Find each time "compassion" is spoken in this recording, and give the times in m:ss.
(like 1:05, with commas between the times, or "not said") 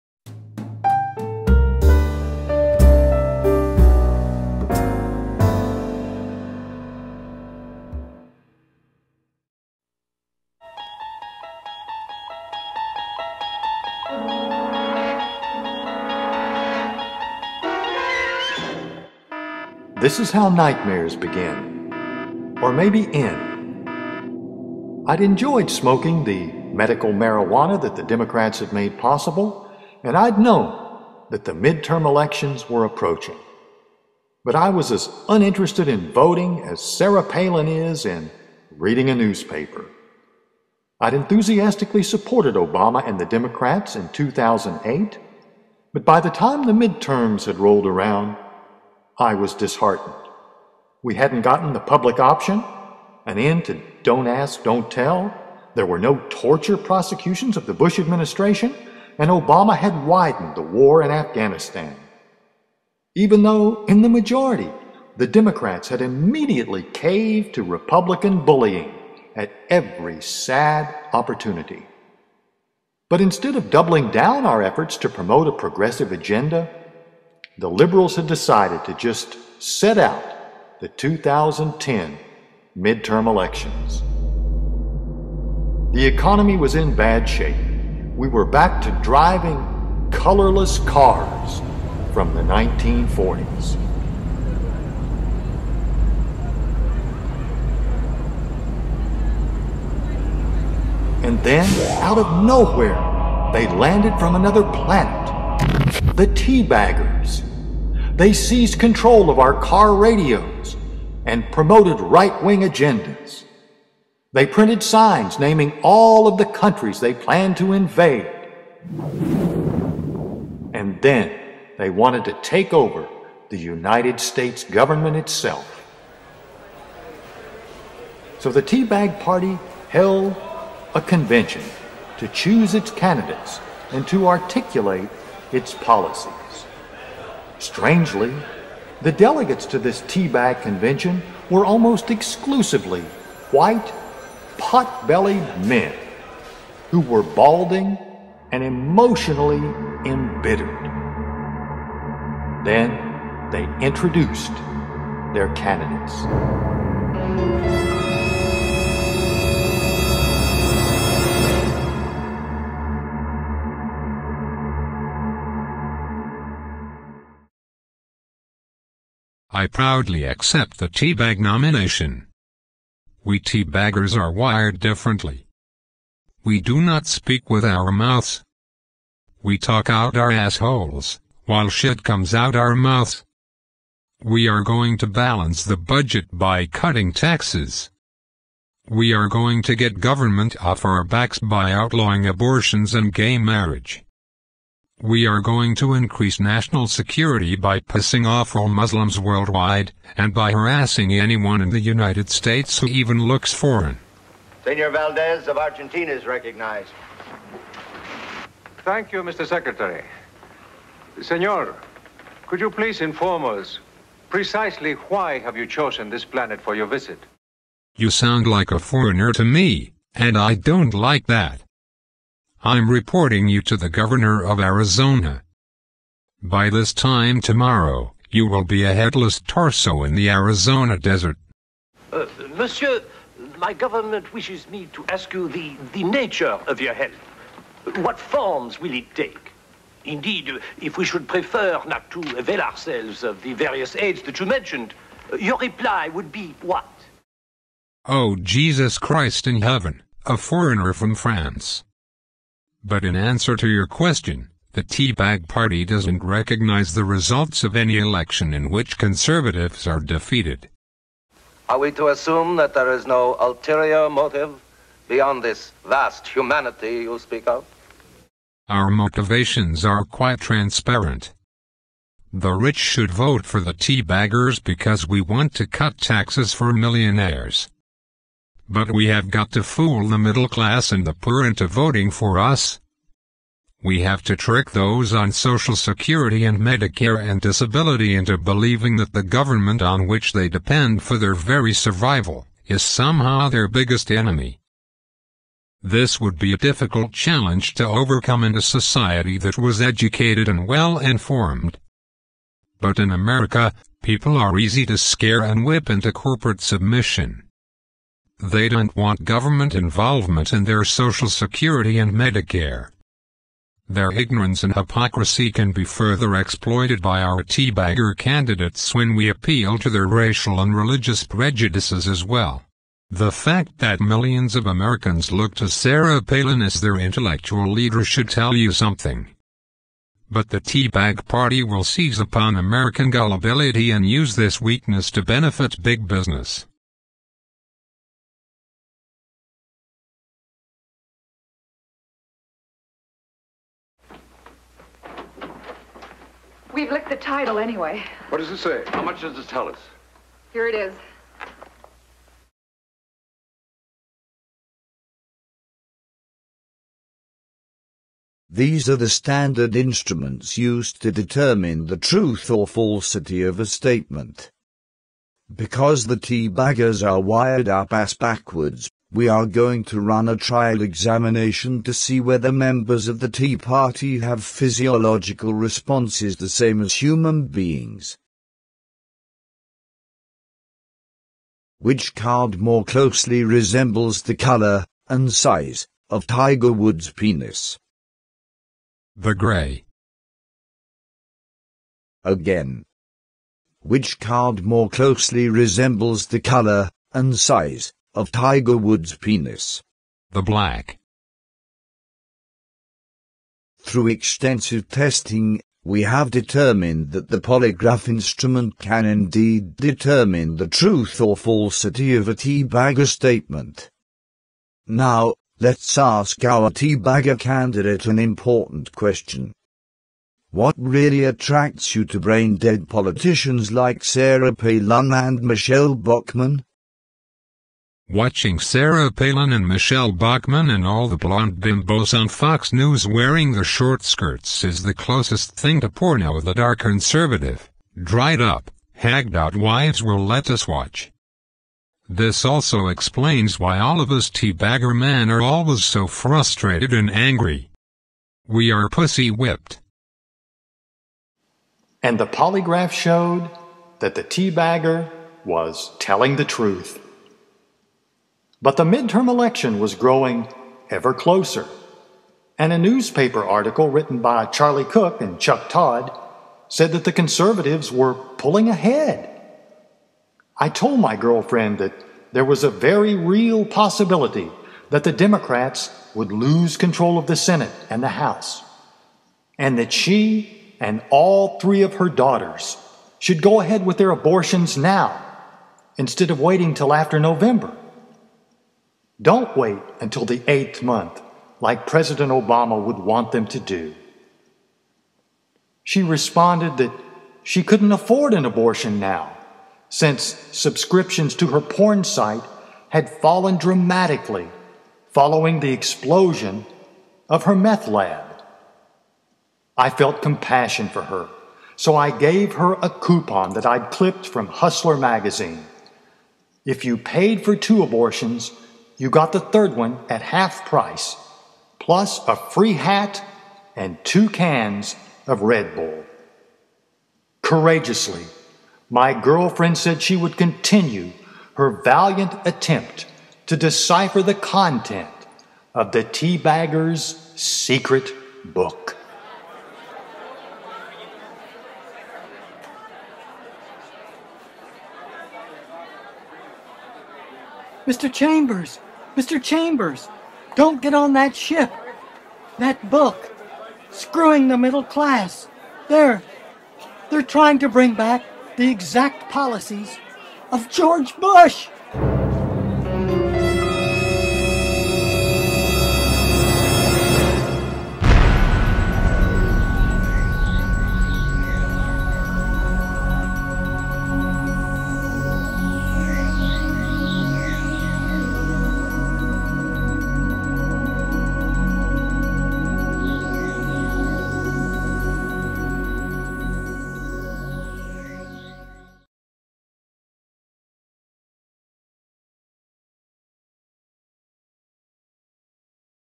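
8:30.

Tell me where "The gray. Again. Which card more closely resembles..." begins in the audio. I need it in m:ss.
6:29.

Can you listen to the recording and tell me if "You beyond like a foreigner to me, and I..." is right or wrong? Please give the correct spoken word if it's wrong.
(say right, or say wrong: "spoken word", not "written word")
wrong: "sound", not "beyond".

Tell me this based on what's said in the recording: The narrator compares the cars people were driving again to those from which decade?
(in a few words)
1940s.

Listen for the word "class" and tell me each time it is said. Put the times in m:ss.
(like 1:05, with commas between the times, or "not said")
4:40, 9:14.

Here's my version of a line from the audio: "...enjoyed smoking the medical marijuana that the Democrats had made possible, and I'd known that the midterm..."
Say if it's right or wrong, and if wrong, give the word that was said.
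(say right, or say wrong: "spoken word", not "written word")
right.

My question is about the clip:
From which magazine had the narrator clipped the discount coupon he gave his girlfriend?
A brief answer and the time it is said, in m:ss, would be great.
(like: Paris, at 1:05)
Hustler, at 8:34.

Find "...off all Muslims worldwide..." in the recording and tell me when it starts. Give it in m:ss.
3:18.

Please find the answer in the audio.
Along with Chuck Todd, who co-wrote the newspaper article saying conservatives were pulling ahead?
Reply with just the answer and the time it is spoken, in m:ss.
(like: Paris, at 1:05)
Charlie Cook, at 7:44.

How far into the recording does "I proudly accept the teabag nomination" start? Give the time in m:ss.
2:49.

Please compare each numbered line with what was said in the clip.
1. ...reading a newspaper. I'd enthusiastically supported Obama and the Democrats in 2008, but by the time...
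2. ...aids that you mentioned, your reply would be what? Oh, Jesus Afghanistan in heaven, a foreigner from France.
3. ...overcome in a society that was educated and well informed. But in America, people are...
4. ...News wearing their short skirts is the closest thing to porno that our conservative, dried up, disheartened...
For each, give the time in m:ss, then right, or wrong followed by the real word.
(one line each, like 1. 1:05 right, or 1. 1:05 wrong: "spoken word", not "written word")
1. 0:38 right
2. 4:03 wrong: "Christ", not "Afghanistan"
3. 4:57 right
4. 7:12 wrong: "hagged", not "disheartened".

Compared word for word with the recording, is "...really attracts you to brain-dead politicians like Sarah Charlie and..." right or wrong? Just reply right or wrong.
wrong.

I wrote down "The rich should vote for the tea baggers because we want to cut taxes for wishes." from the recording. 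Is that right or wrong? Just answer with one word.
wrong.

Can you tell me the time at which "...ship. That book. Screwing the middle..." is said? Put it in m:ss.
9:11.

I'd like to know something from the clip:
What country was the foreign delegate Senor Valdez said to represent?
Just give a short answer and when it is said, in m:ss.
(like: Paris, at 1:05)
Argentina, at 3:25.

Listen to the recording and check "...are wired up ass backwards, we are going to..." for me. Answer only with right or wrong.
right.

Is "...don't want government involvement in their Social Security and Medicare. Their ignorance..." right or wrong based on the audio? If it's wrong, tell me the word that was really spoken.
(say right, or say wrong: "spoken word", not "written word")
right.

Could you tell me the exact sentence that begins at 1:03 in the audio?
Even though, in the majority, the Democrats had immediately caved to Republican bullying at every sad opportunity.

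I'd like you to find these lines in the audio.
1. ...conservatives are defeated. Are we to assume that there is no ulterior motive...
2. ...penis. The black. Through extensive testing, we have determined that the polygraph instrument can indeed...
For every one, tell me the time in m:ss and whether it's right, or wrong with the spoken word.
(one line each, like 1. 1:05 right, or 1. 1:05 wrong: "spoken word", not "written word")
1. 4:18 right
2. 6:39 right.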